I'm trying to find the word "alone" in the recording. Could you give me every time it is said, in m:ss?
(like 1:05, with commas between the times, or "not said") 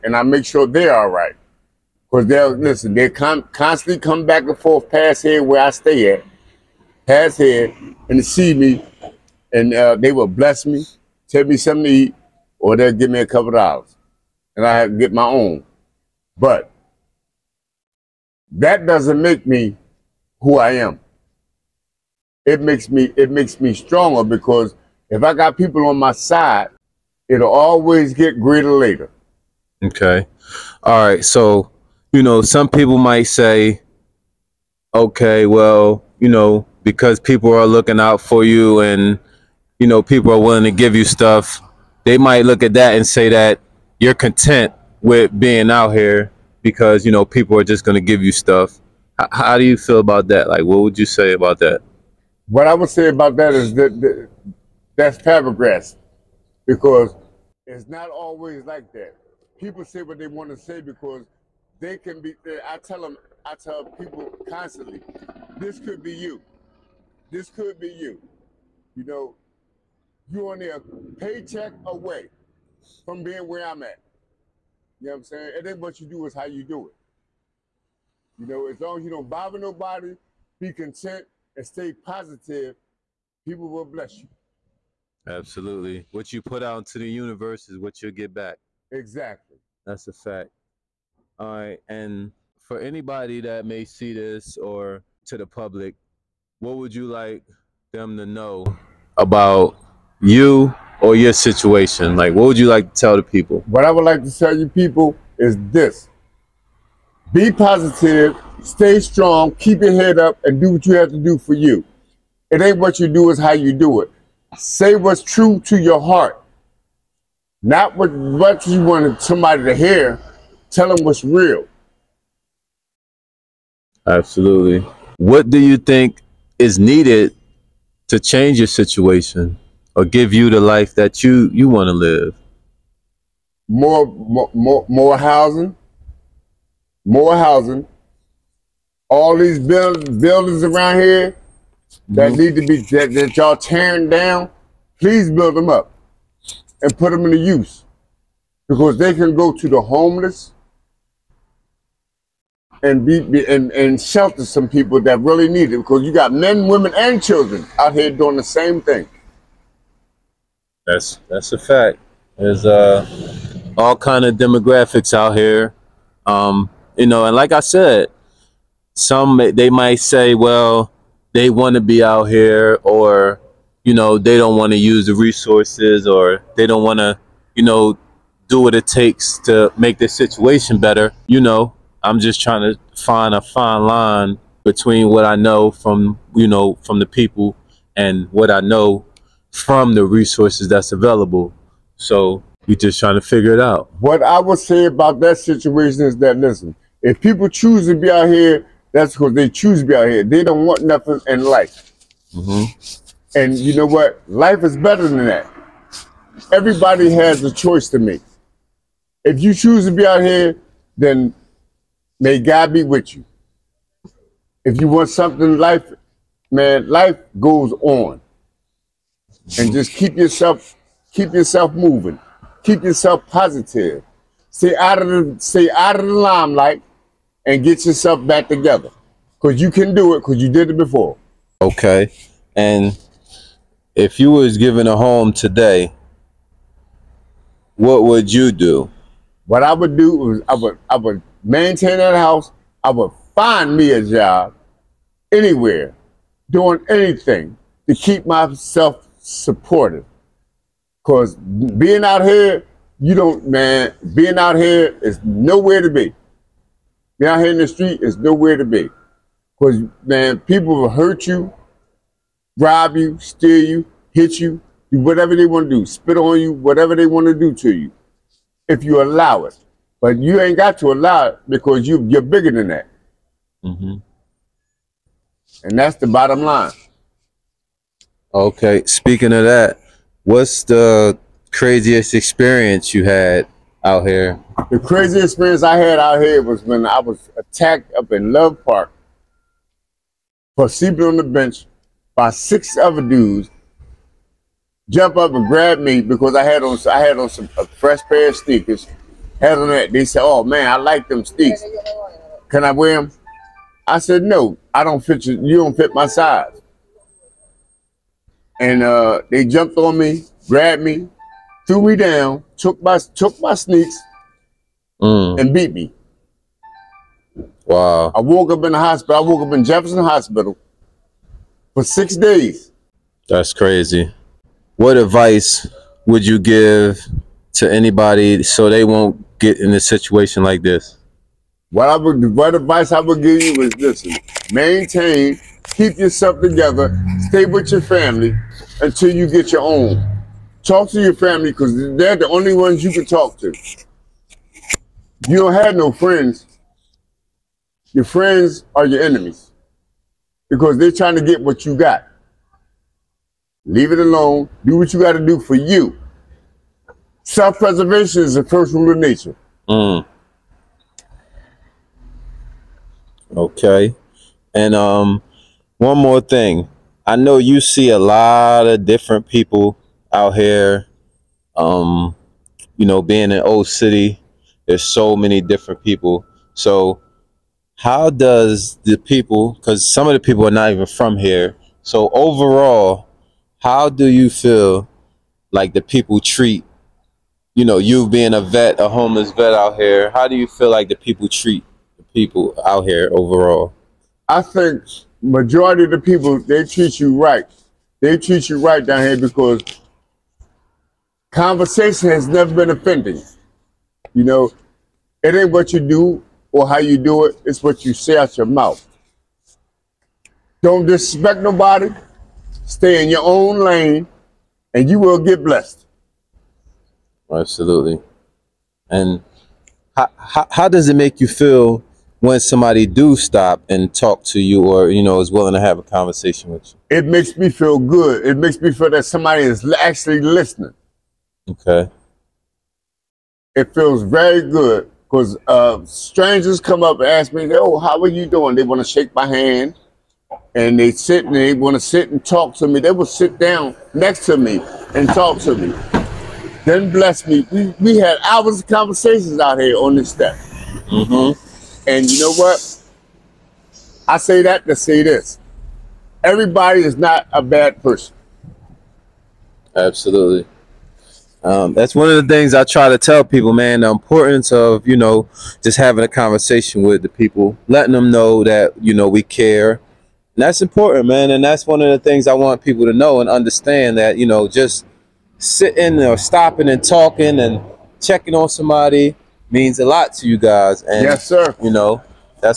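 5:53.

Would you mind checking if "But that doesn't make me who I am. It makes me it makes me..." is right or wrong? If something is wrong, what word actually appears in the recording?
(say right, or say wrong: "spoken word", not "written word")
right.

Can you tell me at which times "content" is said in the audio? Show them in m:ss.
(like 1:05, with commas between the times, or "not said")
0:44, 1:20.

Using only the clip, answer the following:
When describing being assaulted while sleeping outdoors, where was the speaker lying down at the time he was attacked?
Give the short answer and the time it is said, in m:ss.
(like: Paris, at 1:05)
Love Park, at 4:48.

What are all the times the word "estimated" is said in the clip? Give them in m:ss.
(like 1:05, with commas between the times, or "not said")
not said.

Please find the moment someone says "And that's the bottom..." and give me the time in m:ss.
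4:35.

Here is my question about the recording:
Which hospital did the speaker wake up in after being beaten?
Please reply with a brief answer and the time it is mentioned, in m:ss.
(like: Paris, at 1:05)
Jefferson Hospital, at 5:19.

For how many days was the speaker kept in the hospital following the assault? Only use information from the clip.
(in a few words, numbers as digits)
6.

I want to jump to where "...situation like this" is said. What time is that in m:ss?
5:29.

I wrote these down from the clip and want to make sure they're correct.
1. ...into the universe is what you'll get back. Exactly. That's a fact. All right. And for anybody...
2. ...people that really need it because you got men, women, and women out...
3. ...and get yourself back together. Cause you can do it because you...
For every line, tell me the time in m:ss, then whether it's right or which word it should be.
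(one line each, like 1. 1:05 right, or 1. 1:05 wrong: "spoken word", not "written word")
1. 1:26 right
2. 2:34 wrong: "children", not "women"
3. 3:47 right.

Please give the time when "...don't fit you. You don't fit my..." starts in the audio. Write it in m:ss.
5:04.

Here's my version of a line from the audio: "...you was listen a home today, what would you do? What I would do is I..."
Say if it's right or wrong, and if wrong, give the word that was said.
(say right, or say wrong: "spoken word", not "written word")
wrong: "given", not "listen".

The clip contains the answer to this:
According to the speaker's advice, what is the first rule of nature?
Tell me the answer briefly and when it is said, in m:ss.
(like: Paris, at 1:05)
Self preservation, at 5:57.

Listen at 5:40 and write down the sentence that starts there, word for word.
Talk to your family because they're the only ones you can talk to.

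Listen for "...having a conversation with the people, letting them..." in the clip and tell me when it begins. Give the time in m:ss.
7:45.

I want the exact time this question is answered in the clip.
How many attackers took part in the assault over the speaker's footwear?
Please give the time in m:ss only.
4:52.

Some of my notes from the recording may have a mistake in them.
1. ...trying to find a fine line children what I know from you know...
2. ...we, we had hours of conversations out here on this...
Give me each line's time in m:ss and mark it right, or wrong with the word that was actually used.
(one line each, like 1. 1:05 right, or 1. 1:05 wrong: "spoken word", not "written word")
1. 3:02 wrong: "between", not "children"
2. 7:27 right.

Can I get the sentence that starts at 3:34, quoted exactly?
If you want something in life, man, life goes on and just keep yourself keep yourself moving.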